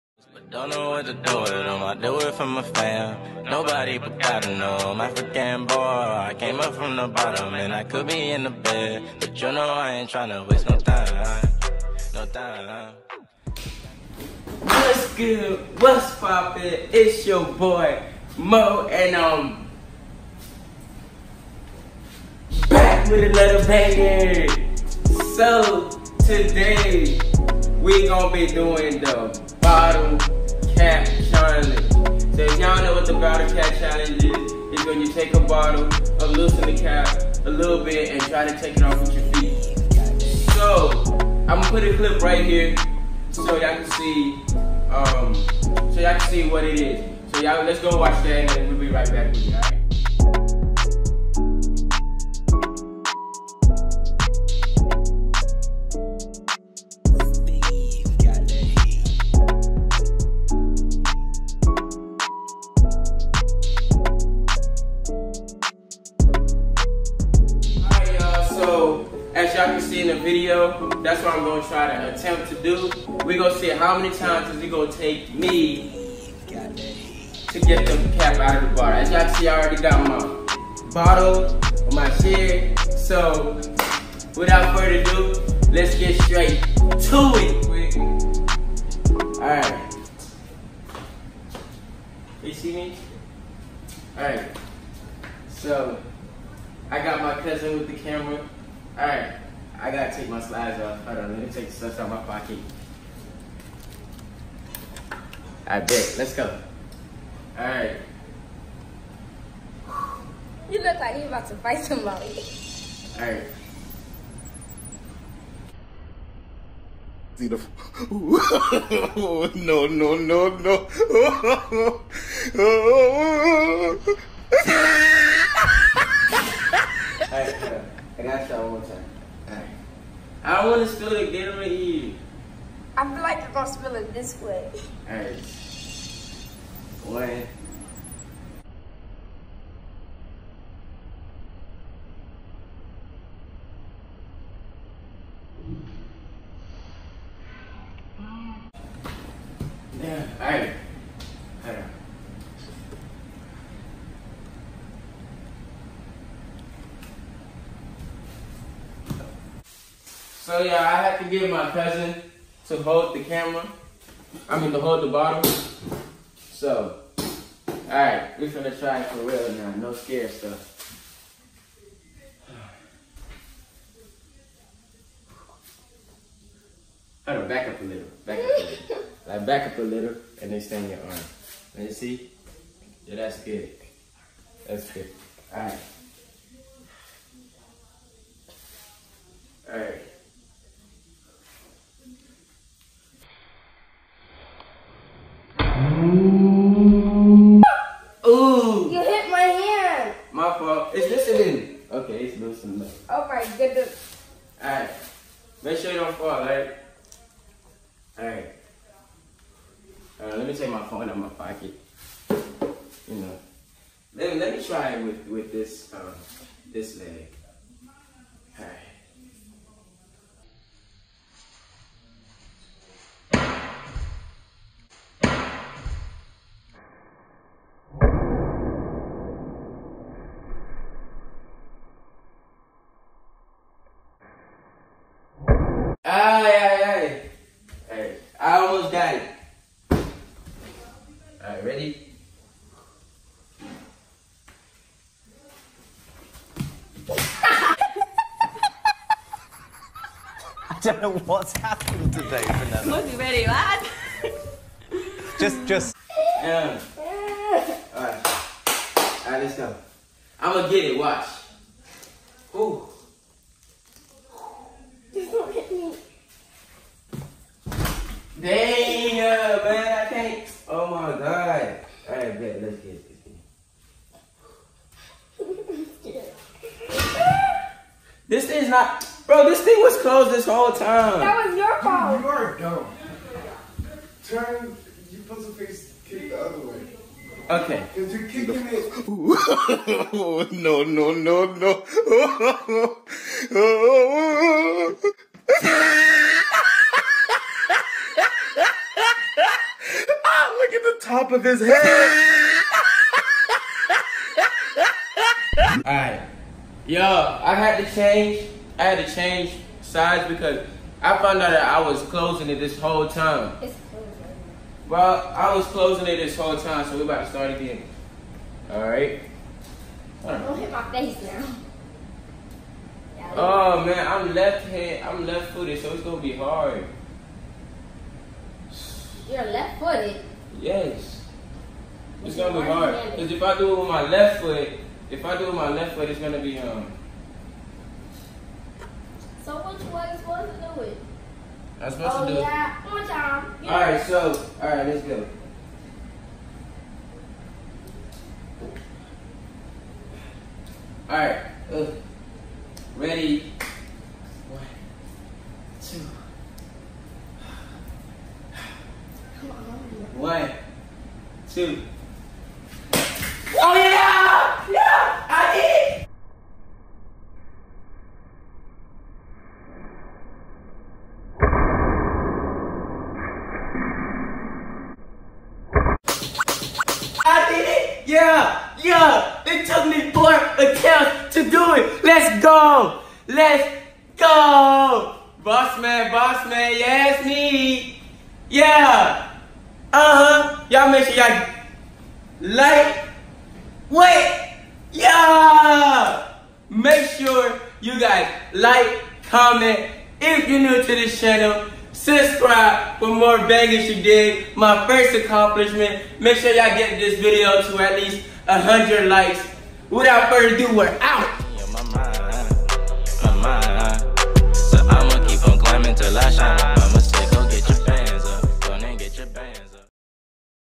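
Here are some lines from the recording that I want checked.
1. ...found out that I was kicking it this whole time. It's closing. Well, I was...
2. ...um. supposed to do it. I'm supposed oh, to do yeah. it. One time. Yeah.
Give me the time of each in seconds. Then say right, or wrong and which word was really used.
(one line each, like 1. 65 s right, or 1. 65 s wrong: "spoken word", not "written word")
1. 311 s wrong: "closing", not "kicking"
2. 336 s right.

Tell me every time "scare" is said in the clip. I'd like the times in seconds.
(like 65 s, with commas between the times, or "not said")
169 s.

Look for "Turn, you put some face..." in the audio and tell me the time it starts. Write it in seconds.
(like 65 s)
284 s.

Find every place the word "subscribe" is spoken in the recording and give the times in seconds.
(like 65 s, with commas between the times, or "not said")
401 s.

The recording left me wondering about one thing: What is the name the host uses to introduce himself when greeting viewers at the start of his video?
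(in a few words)
Mo.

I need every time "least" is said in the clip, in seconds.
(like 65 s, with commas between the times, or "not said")
407 s.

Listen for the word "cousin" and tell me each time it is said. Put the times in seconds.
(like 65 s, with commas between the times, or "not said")
97 s, 161 s.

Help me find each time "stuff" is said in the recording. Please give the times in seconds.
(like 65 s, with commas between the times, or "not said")
101 s, 170 s.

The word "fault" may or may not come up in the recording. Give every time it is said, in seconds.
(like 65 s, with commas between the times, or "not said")
200 s, 281 s.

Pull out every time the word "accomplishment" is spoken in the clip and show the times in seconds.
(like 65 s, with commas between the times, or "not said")
405 s.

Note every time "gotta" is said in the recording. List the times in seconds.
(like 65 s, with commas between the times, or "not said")
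99 s.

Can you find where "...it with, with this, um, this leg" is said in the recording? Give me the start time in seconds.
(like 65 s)
214 s.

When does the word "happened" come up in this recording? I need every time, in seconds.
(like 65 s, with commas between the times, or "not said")
251 s.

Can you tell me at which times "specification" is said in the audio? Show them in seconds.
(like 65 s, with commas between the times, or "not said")
not said.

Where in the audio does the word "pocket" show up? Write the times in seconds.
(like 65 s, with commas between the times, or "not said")
102 s, 211 s.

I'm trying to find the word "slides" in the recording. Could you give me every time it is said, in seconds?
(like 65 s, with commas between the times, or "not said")
100 s.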